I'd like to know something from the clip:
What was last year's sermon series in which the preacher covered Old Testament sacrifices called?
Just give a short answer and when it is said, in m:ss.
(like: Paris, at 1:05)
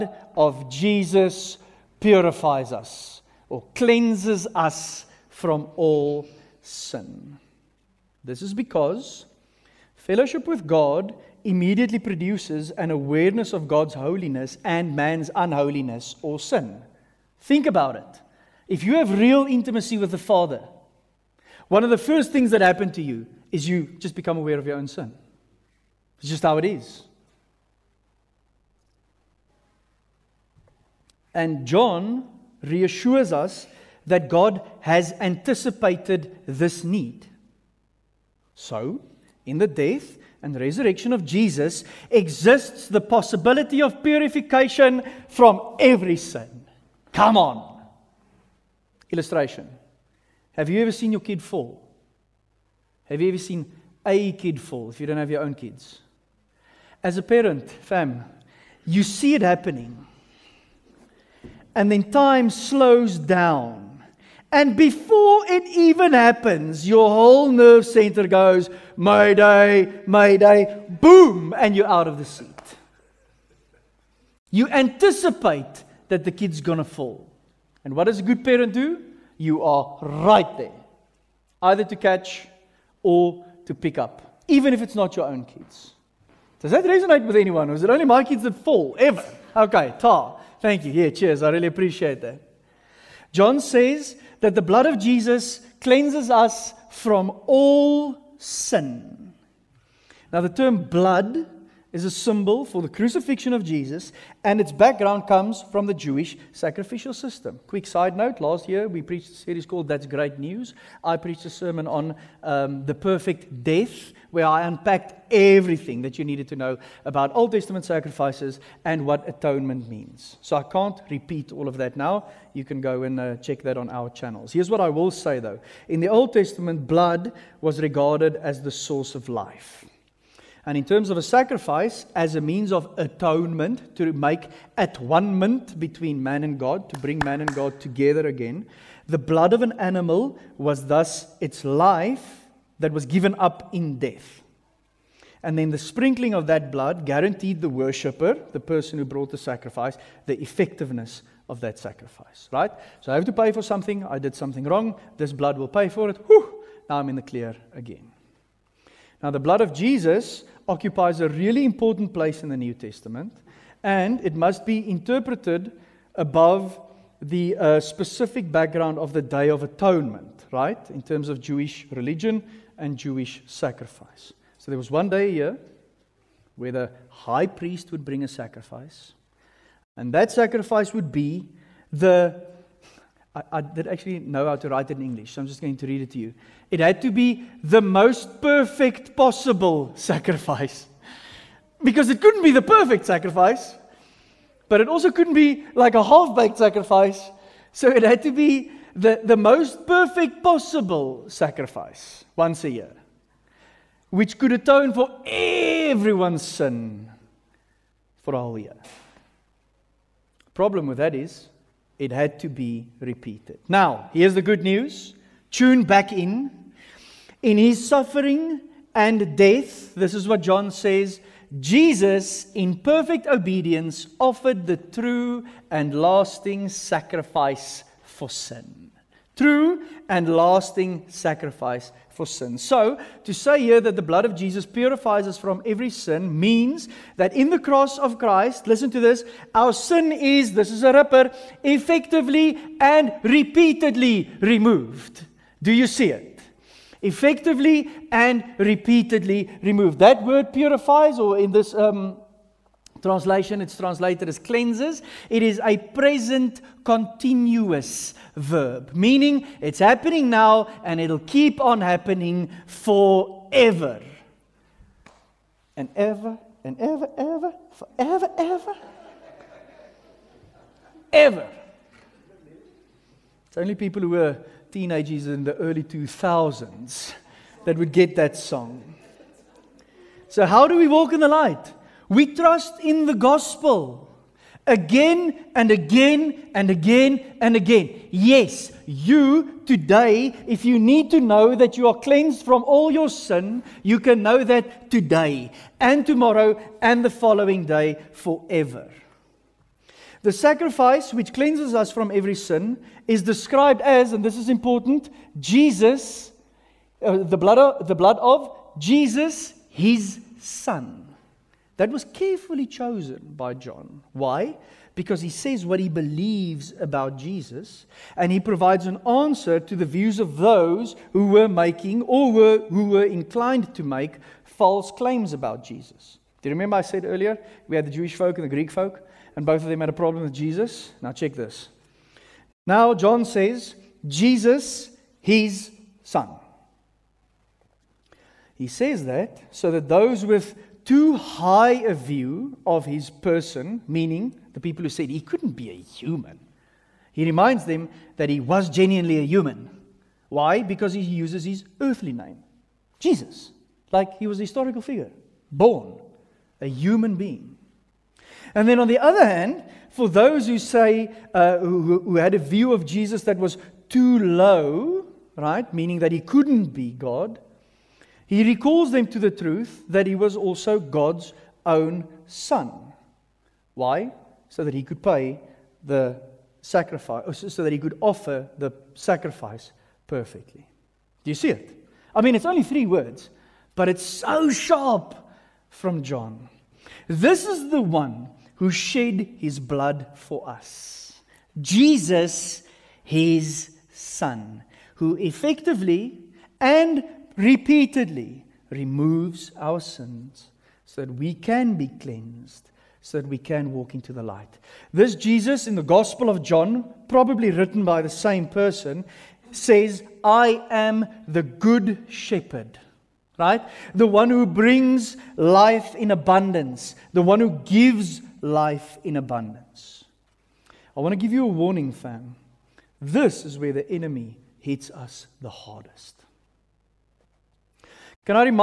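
That's Great News, at 1:49.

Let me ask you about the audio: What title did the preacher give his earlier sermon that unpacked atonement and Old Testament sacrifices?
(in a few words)
The perfect death.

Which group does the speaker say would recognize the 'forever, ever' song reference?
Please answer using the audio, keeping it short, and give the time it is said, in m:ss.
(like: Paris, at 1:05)
Teenagers in the early 2000s, at 4:34.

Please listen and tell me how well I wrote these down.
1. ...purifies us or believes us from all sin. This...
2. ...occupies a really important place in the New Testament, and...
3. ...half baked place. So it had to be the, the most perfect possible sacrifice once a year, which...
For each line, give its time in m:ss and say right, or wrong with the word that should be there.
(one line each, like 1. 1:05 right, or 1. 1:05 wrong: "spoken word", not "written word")
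1. 0:01 wrong: "cleanses", not "believes"
2. 2:40 right
3. 3:16 wrong: "sacrifice", not "place".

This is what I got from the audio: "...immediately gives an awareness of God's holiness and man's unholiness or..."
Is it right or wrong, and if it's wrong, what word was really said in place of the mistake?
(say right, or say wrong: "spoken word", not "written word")
wrong: "produces", not "gives".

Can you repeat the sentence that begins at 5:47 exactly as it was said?
He reminds them that he was genuinely a human.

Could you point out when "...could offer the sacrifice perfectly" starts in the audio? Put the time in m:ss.
6:17.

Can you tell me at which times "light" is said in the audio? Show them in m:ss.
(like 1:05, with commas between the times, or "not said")
4:41, 6:44.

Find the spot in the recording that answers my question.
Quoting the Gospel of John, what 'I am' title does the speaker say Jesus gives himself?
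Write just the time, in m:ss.
6:51.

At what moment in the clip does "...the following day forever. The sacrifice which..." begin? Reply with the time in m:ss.
4:57.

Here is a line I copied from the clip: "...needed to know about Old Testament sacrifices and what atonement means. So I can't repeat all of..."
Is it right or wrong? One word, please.
right.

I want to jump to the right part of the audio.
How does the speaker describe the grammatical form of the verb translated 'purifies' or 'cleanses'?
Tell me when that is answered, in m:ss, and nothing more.
4:15.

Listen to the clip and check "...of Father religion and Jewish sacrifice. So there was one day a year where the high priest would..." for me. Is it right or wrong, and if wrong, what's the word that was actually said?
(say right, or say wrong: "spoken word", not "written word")
wrong: "Jewish", not "Father".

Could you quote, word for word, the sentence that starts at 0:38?
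So, in the death and resurrection of Jesus exists the possibility of purification from every sin.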